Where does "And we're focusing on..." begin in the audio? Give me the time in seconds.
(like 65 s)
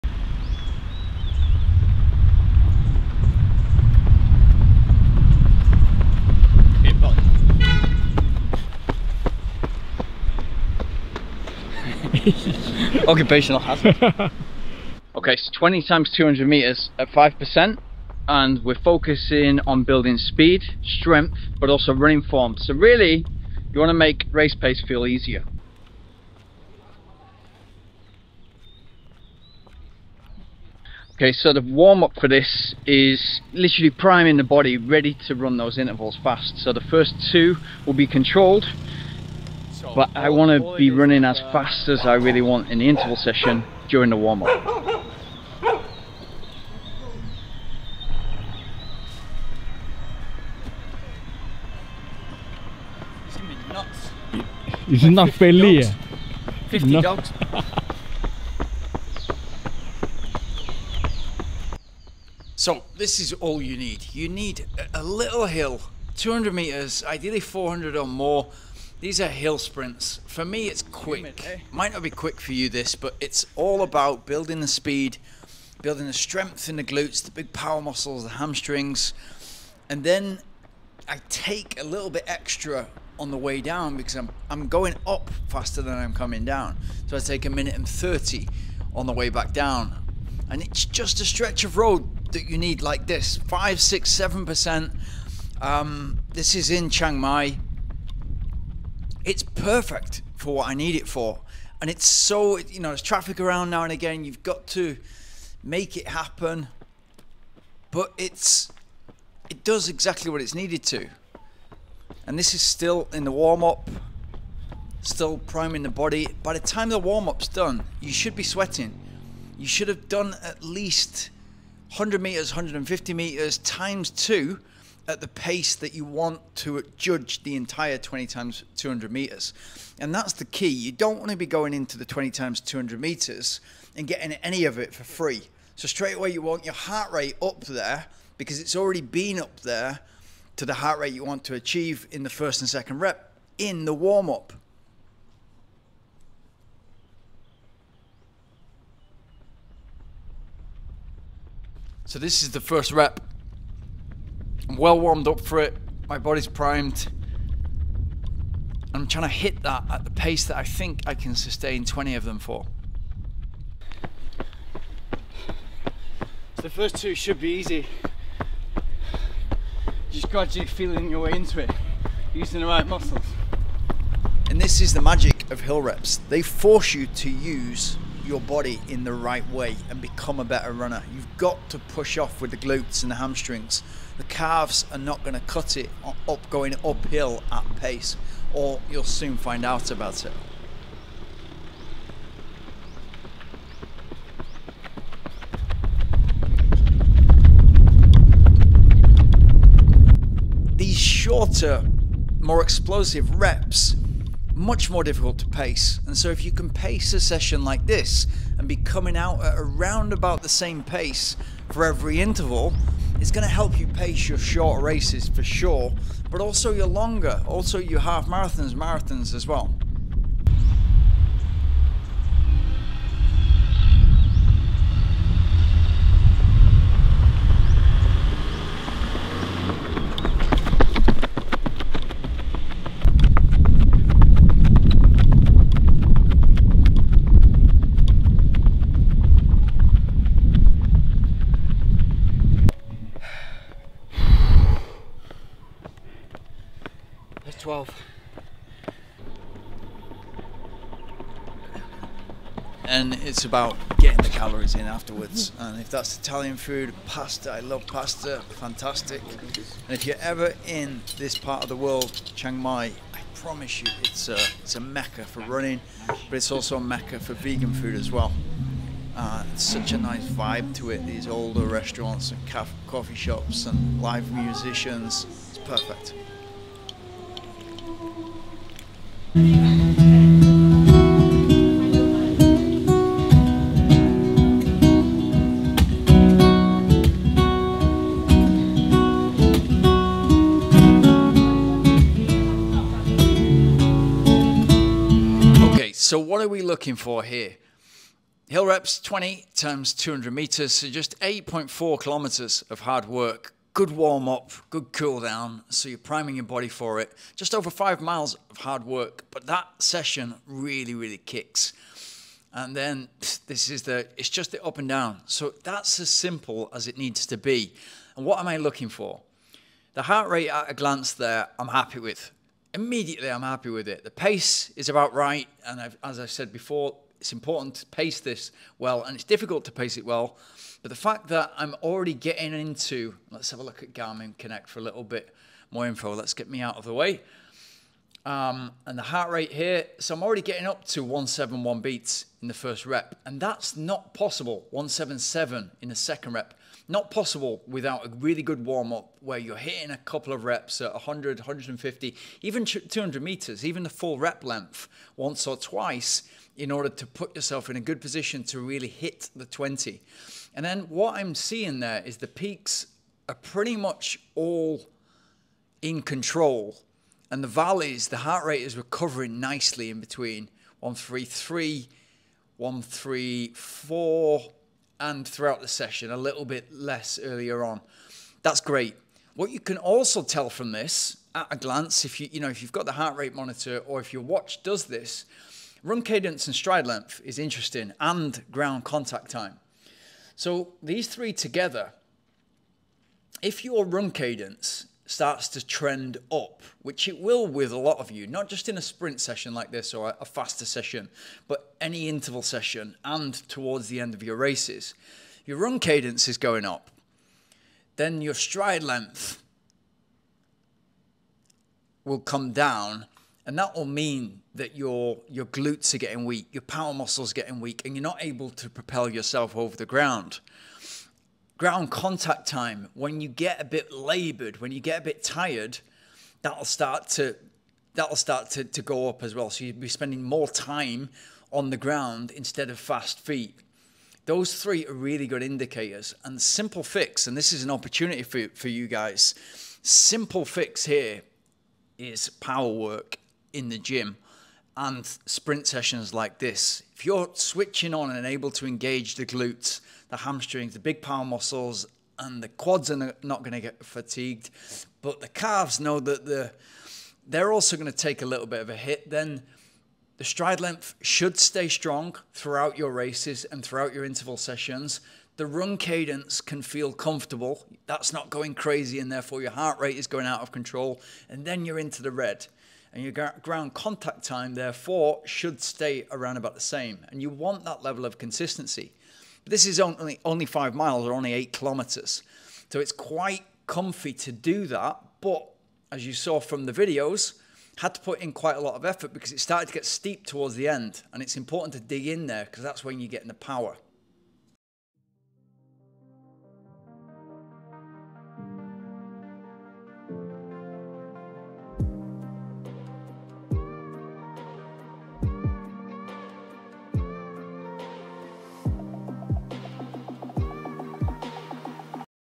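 18 s.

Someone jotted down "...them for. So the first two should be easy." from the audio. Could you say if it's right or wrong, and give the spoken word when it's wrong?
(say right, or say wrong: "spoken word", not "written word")
right.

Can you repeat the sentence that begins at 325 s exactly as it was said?
And I've, as I said before, it's important to pace this well, and it's difficult to pace it well.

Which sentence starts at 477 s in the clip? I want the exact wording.
And you want that level of consistency.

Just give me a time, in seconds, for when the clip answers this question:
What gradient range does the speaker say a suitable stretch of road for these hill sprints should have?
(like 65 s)
93 s.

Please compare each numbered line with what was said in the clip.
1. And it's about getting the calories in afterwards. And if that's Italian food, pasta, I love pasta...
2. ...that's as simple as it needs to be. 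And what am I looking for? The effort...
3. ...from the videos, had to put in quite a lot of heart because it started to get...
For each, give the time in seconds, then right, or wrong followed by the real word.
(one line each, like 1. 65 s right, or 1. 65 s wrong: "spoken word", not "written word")
1. 252 s right
2. 315 s wrong: "heart", not "effort"
3. 486 s wrong: "effort", not "heart".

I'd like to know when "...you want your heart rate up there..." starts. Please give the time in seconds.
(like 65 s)
136 s.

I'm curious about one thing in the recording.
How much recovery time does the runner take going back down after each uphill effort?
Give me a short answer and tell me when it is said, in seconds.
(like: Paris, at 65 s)
1 minute 30, at 87 s.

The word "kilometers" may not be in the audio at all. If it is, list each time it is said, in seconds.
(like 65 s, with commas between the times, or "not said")
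301 s, 481 s.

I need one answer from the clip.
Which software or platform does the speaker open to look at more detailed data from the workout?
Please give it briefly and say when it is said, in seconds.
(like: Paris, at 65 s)
Garmin Connect, at 333 s.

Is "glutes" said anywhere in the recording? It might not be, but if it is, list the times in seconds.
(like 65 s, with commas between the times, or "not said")
76 s, 182 s, 415 s, 449 s.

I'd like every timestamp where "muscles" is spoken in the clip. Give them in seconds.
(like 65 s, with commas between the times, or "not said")
77 s, 172 s, 416 s, 451 s.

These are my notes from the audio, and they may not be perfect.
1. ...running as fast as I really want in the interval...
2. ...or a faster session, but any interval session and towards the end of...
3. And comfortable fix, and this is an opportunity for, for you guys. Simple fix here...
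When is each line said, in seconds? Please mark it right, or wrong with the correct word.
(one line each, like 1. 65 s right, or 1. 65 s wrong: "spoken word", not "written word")
1. 40 s right
2. 399 s right
3. 436 s wrong: "simple", not "comfortable".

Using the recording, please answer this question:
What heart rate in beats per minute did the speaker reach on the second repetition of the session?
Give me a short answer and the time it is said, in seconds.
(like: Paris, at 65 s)
177, at 344 s.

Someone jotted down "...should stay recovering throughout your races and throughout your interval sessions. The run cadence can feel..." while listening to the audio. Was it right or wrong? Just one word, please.
wrong.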